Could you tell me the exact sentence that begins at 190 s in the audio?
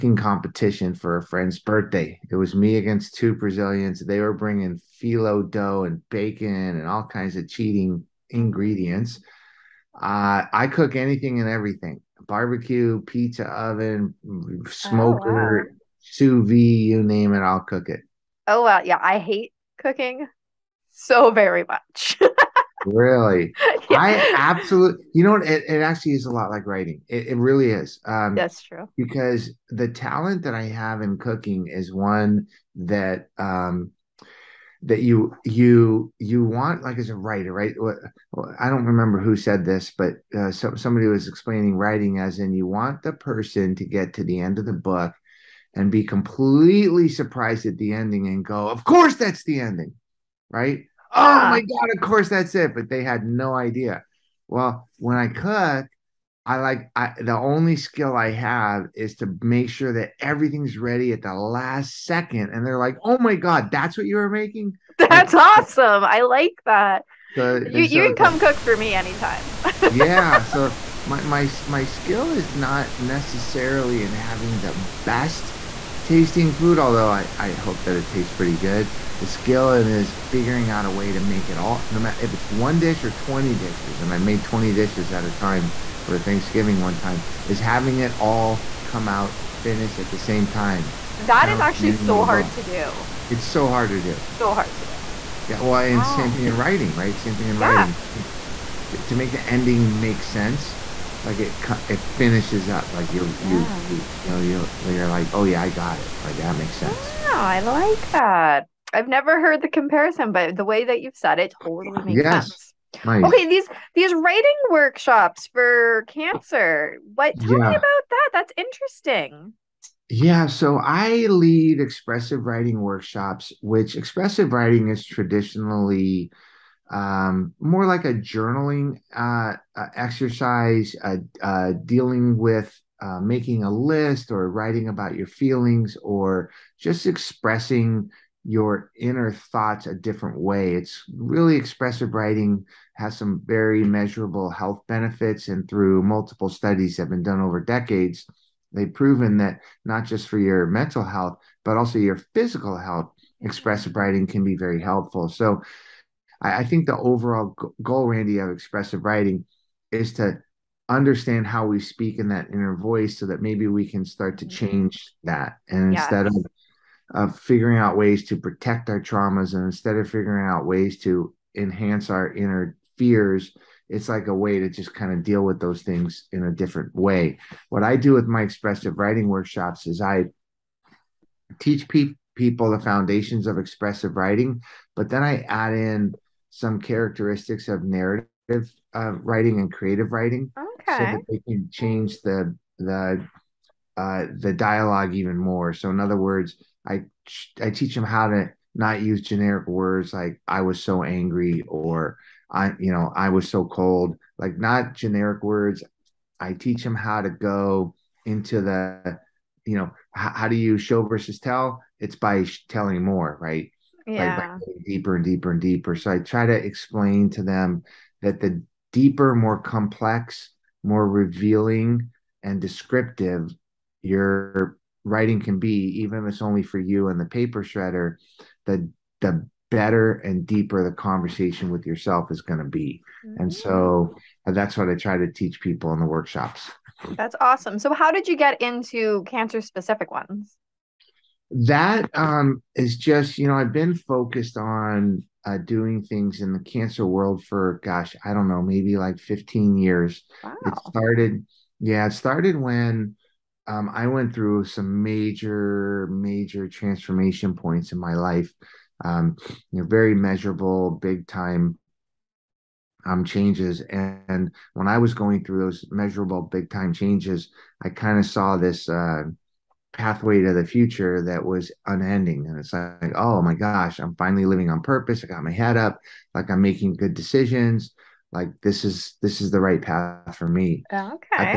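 so that they can change the the uh, the dialogue even more.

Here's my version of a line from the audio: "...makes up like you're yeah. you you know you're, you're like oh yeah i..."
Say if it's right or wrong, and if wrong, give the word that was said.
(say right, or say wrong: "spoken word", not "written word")
wrong: "finishes", not "makes".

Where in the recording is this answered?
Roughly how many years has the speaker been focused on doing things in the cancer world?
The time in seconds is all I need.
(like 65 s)
249 s.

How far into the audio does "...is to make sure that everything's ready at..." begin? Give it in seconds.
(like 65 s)
58 s.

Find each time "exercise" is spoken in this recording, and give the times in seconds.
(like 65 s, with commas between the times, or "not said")
129 s.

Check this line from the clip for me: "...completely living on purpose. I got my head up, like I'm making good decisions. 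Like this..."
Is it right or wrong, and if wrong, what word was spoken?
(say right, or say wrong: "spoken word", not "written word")
wrong: "finally", not "completely".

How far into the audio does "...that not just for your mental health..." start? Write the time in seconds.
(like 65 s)
149 s.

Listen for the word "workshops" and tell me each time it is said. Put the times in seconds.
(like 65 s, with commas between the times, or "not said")
114 s, 122 s, 179 s, 236 s.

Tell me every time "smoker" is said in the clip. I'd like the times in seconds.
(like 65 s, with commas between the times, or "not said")
14 s.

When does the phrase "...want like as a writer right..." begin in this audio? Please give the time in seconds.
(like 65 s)
36 s.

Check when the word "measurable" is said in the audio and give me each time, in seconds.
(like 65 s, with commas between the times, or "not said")
143 s, 260 s, 265 s.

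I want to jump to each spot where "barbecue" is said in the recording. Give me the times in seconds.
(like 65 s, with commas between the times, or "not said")
12 s.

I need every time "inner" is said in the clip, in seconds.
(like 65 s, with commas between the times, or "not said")
138 s, 162 s, 172 s.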